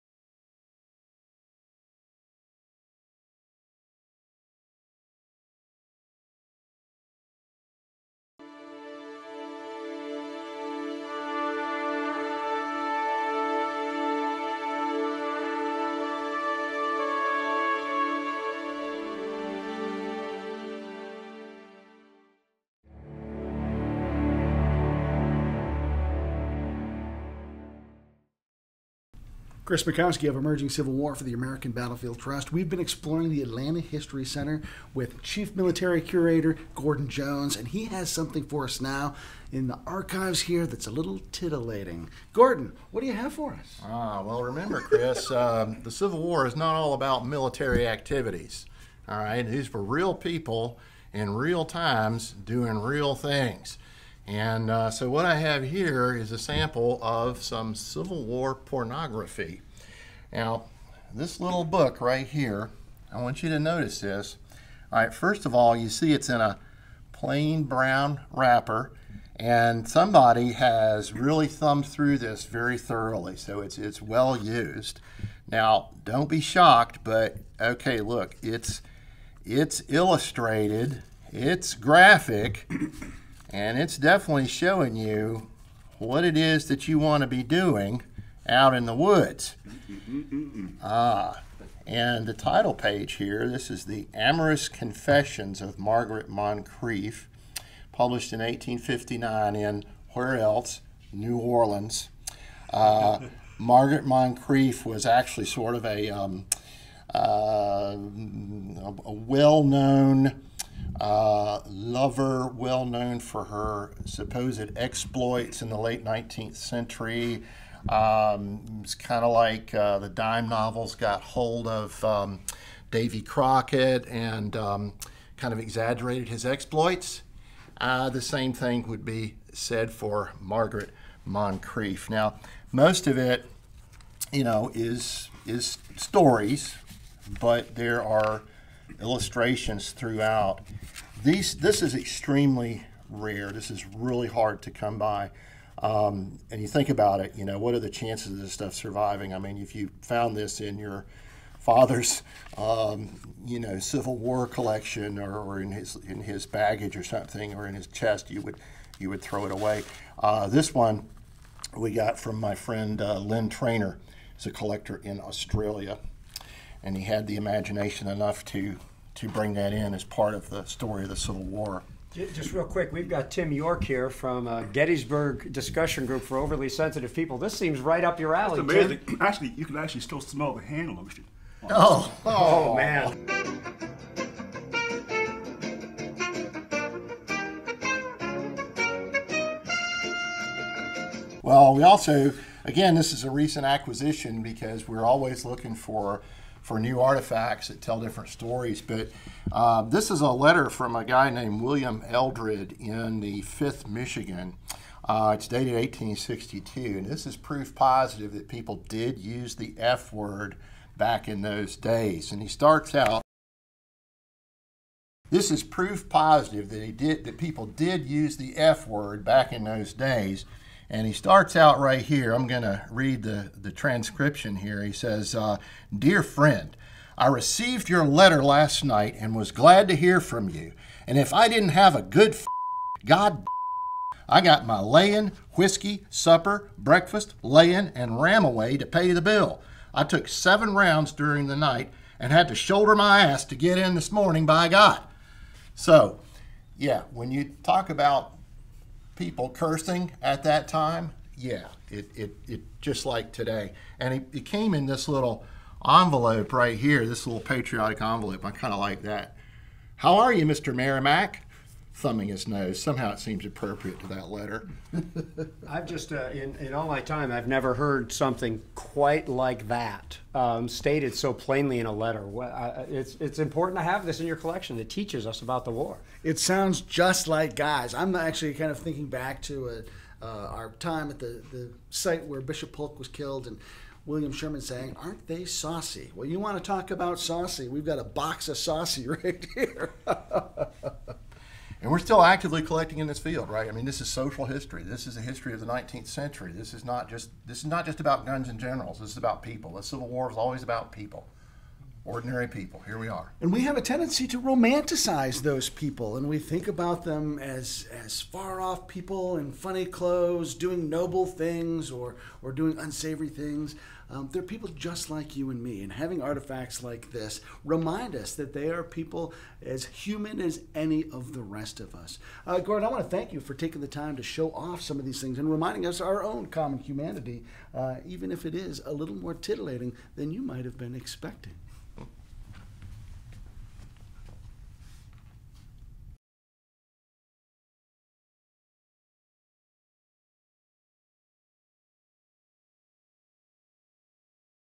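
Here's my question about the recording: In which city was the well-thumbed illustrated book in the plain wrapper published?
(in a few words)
New Orleans.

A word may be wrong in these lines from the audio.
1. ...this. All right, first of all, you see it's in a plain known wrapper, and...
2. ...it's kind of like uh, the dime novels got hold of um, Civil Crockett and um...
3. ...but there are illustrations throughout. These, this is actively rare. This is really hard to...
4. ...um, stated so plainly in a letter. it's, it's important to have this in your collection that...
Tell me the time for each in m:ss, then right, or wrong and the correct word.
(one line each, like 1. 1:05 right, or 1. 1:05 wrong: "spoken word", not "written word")
1. 1:03 wrong: "brown", not "known"
2. 1:58 wrong: "Davy", not "Civil"
3. 2:17 wrong: "extremely", not "actively"
4. 4:30 right.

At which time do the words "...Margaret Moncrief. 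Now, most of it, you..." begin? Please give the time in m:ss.
2:10.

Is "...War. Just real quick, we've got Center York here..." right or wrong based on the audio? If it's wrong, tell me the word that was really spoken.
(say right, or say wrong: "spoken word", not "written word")
wrong: "Tim", not "Center".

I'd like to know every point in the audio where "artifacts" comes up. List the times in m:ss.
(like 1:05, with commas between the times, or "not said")
3:16, 5:16.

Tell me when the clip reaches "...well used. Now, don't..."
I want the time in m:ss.
1:14.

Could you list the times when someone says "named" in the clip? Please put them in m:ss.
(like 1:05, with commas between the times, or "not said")
3:21.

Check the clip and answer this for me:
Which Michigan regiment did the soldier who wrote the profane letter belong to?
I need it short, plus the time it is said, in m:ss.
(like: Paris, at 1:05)
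5th Michigan, at 3:23.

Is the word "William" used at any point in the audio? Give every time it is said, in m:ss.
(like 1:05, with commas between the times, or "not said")
3:21, 4:44.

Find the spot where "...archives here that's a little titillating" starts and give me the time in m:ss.
0:39.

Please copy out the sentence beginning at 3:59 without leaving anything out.
I took seven rounds during the night and had to shoulder my ass to get in this morning by God.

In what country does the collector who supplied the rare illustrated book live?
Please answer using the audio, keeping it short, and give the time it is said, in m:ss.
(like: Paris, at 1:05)
Australia, at 2:45.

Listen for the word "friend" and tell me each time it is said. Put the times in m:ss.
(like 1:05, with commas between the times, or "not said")
2:42, 3:46.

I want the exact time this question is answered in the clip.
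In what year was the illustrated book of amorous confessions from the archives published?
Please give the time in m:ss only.
1:38.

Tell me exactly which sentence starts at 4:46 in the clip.
Well, you want to talk about saucy?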